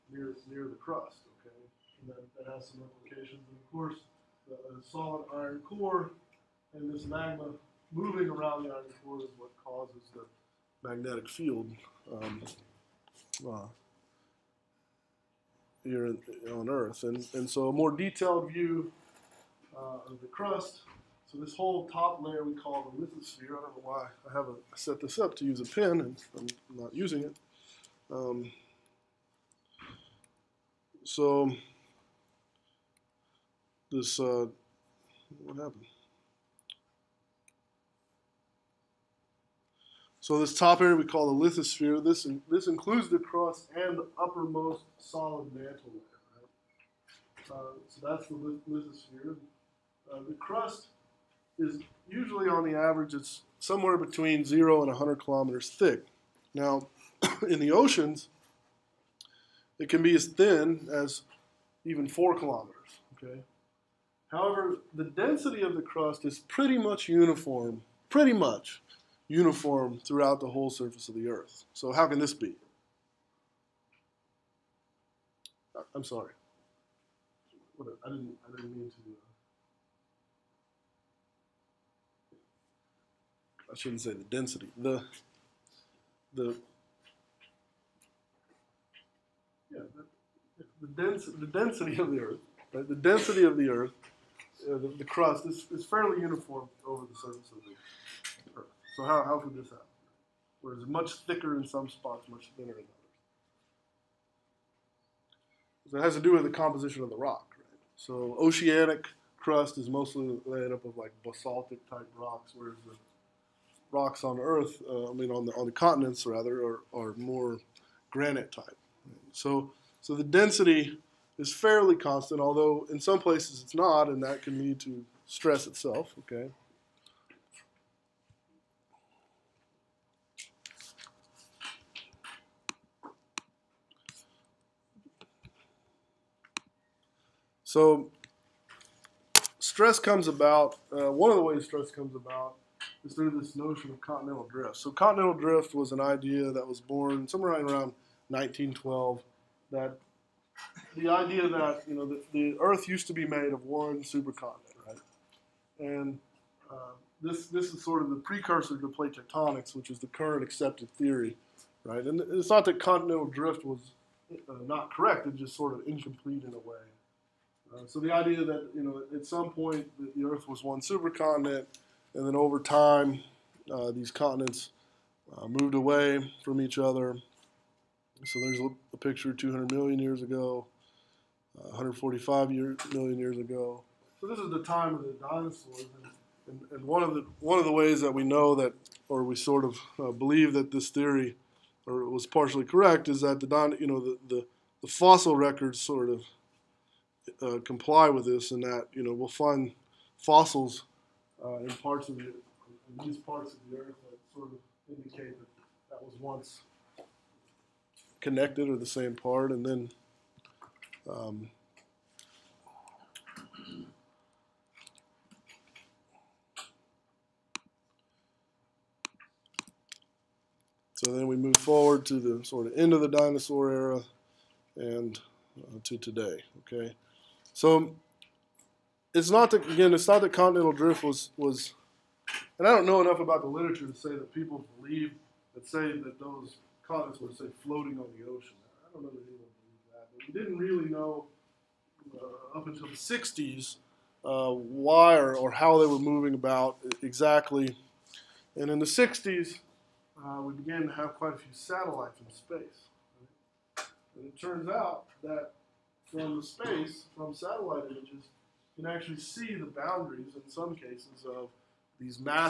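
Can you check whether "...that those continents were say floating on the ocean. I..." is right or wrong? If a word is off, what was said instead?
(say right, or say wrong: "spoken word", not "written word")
right.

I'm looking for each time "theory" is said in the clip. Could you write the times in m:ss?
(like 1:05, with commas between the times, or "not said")
2:40, 3:10.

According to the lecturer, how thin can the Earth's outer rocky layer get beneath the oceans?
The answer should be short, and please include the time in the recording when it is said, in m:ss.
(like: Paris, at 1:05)
4 kilometers, at 1:02.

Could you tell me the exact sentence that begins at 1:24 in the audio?
The, the, yeah, the, the, dens the density of the earth, right?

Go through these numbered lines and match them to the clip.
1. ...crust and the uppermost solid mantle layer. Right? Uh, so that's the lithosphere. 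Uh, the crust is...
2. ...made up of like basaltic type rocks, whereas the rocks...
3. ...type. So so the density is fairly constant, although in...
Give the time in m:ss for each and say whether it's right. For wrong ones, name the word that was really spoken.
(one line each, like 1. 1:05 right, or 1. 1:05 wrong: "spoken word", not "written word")
1. 0:43 right
2. 1:50 right
3. 1:58 right.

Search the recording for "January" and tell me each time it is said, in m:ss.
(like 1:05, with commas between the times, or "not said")
not said.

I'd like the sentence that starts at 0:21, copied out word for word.
So this whole top layer we call the lithosphere.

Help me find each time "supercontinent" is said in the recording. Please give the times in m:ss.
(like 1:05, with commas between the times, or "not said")
2:34, 2:50.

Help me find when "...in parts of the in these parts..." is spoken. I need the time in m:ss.
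3:21.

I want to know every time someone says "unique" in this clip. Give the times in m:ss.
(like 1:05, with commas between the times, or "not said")
not said.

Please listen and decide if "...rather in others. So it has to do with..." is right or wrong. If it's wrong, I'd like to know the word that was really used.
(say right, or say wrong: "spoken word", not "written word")
wrong: "thinner", not "rather".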